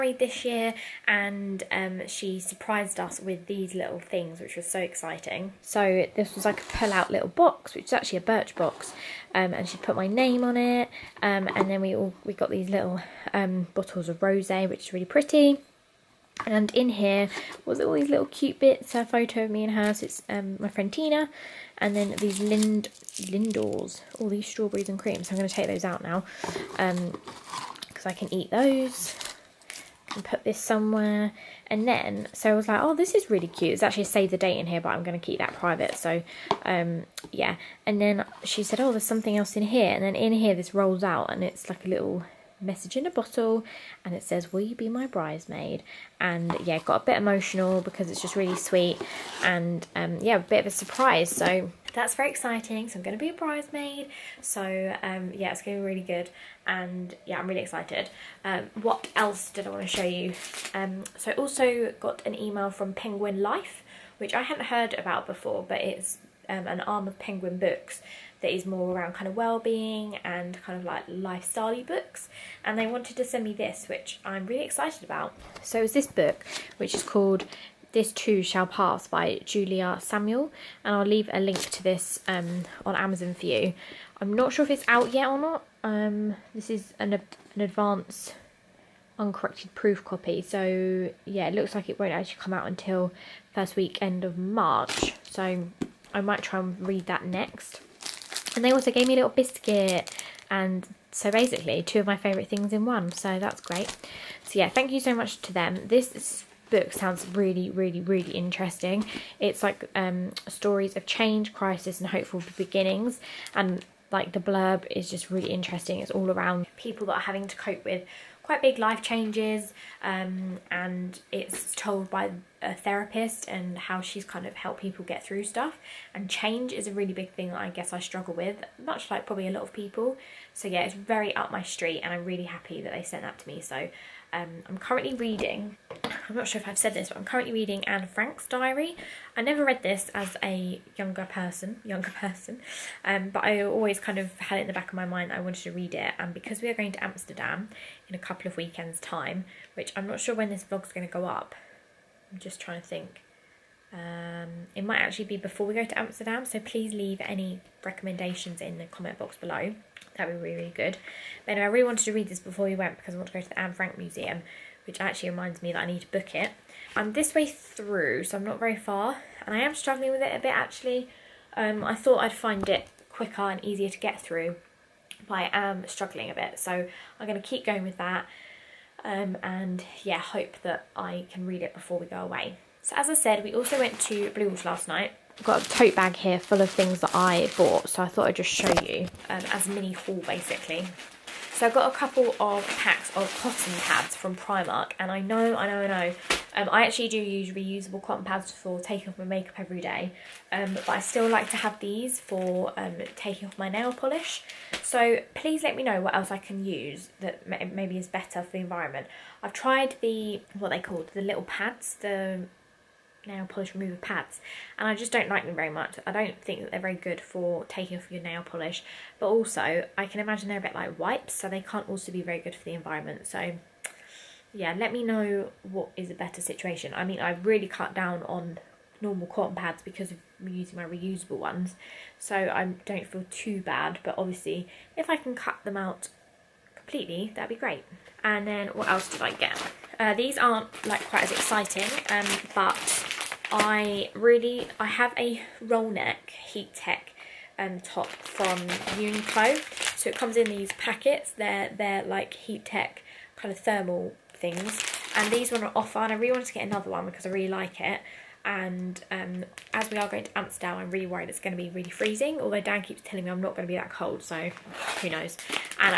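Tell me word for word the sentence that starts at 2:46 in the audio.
I'm this way through, so I'm not very far, and I am struggling with it a bit actually.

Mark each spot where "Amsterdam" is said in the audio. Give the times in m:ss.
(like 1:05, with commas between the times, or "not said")
2:27, 2:35, 4:20.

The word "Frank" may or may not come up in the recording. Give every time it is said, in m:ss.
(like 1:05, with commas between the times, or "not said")
2:18, 2:43.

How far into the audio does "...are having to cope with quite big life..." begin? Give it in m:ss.
1:57.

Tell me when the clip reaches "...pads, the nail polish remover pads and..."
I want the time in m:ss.
3:31.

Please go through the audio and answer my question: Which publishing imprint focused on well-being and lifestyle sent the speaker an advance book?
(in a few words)
Penguin Life.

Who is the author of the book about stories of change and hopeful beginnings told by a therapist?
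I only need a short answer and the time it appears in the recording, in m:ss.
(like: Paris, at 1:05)
Julia Samuel, at 1:19.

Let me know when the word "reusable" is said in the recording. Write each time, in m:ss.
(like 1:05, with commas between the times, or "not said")
3:17, 3:50.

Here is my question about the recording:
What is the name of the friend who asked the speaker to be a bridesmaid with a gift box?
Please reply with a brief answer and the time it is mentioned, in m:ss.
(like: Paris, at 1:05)
Tina, at 0:20.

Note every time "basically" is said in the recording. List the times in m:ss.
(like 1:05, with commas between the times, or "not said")
1:41, 3:10.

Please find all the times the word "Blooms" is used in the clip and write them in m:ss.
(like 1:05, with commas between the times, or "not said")
3:04.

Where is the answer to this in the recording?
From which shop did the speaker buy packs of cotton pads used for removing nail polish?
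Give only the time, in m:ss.
3:14.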